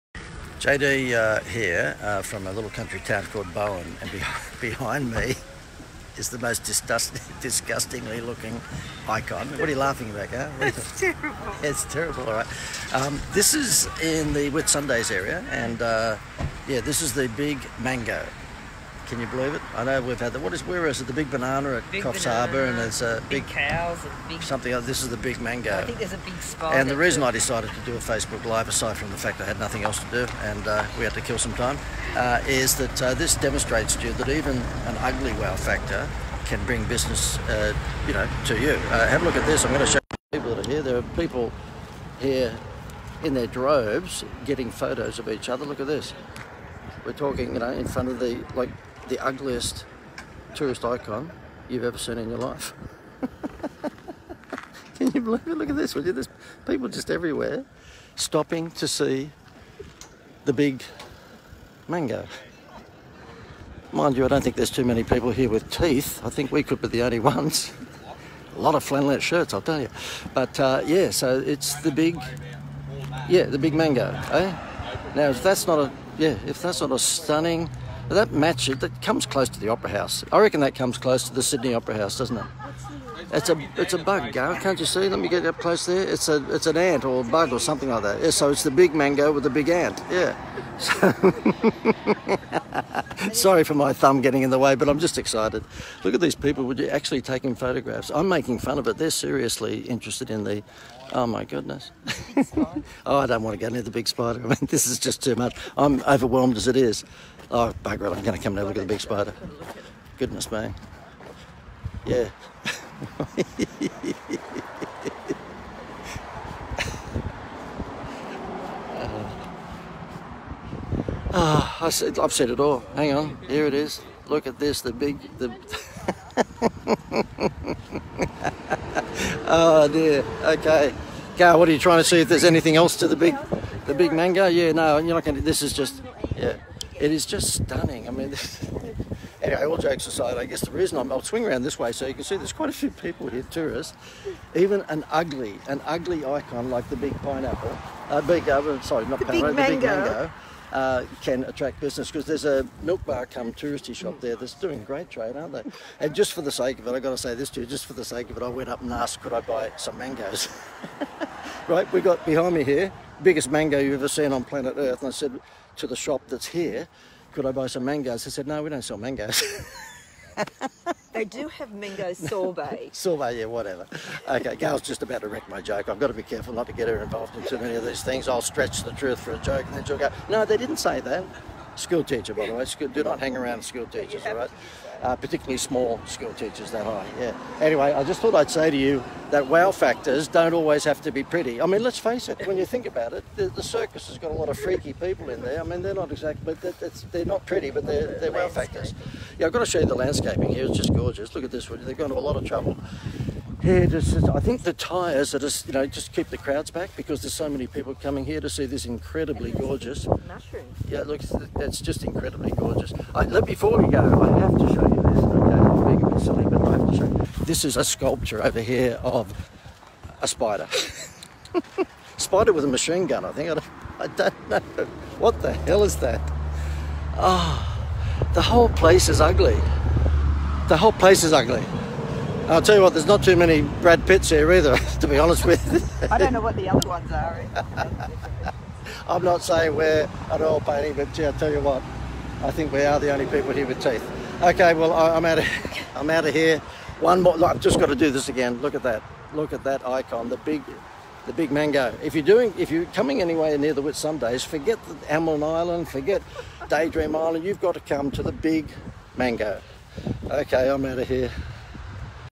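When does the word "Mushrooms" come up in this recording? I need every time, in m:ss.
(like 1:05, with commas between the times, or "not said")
3:30.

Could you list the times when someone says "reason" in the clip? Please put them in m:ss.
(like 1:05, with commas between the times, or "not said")
0:26, 2:20.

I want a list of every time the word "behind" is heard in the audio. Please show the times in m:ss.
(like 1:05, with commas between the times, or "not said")
0:04, 2:42.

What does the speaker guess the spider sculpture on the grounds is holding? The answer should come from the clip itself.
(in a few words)
A machine gun.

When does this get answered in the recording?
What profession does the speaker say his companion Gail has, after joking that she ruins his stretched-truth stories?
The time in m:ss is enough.
3:01.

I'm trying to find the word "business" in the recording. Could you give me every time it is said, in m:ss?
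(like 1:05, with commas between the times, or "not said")
0:36, 2:31.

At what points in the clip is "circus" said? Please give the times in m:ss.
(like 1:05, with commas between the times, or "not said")
3:13.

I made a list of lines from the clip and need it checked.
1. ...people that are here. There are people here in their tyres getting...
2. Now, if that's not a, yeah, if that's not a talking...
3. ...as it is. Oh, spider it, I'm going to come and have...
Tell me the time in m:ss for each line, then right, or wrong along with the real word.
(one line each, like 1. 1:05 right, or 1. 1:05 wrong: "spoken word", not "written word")
1. 0:40 wrong: "droves", not "tyres"
2. 1:15 wrong: "stunning", not "talking"
3. 1:46 wrong: "bugger", not "spider".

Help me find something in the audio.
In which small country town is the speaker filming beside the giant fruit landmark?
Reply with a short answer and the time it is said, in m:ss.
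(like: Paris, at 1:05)
Bowen, at 0:03.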